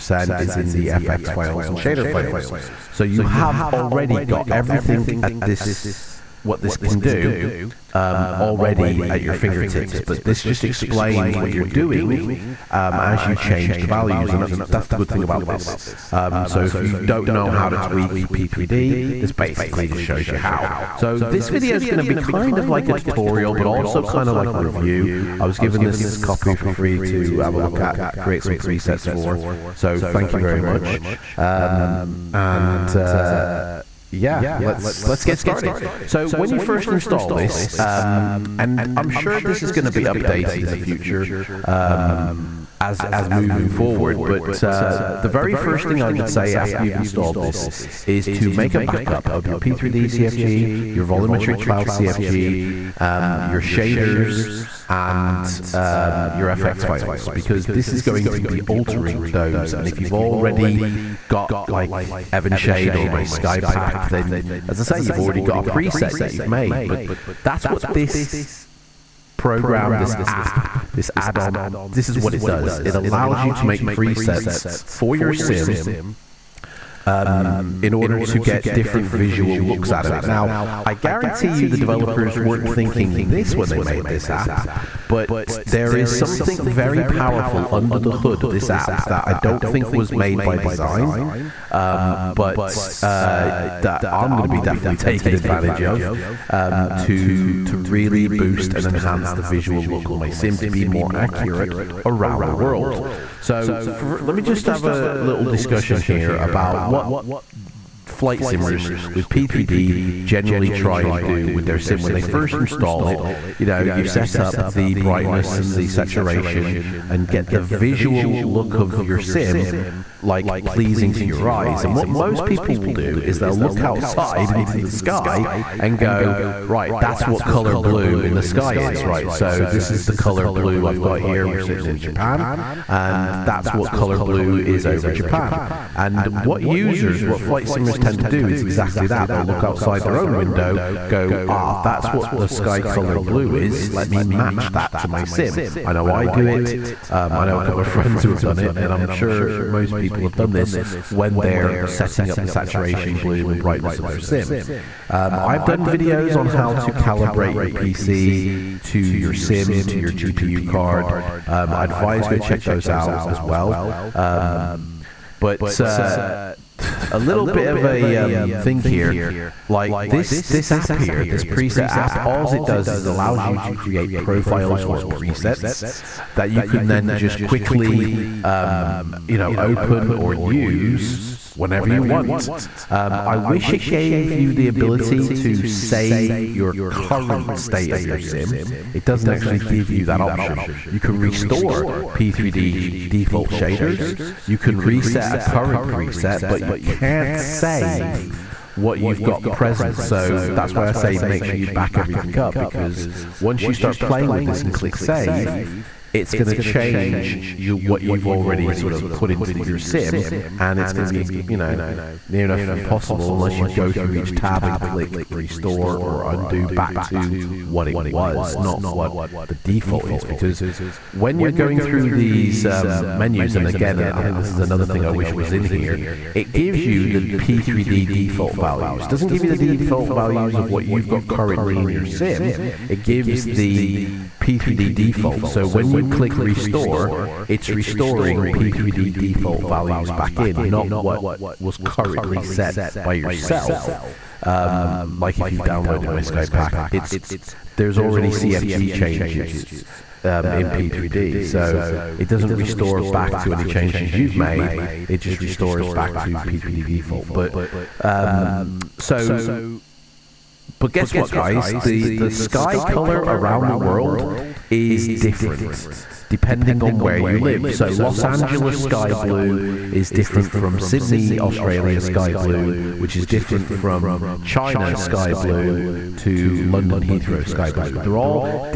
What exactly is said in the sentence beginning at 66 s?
But that's what this program, this app, this add-on this is what it does.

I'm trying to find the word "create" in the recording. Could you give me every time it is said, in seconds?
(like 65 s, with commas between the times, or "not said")
28 s, 173 s.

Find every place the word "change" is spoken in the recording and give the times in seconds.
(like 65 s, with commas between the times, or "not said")
13 s, 206 s, 248 s, 253 s.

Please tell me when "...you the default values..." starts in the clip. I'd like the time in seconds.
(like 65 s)
229 s.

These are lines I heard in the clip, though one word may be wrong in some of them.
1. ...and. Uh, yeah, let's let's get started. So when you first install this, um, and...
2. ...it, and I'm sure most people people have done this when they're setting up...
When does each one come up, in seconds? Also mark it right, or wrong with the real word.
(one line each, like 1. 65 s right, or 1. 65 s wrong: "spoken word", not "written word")
1. 32 s right
2. 148 s right.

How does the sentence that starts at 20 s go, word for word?
So this video is going to be kind of like a tutorial, but also kind of like a review.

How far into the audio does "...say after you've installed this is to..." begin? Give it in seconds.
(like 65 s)
46 s.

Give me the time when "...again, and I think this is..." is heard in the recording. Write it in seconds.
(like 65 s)
223 s.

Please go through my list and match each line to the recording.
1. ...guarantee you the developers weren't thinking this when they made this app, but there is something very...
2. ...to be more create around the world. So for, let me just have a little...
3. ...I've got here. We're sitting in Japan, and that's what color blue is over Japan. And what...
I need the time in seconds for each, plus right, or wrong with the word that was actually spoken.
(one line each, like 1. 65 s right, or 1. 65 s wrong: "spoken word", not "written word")
1. 80 s right
2. 100 s wrong: "accurate", not "create"
3. 130 s right.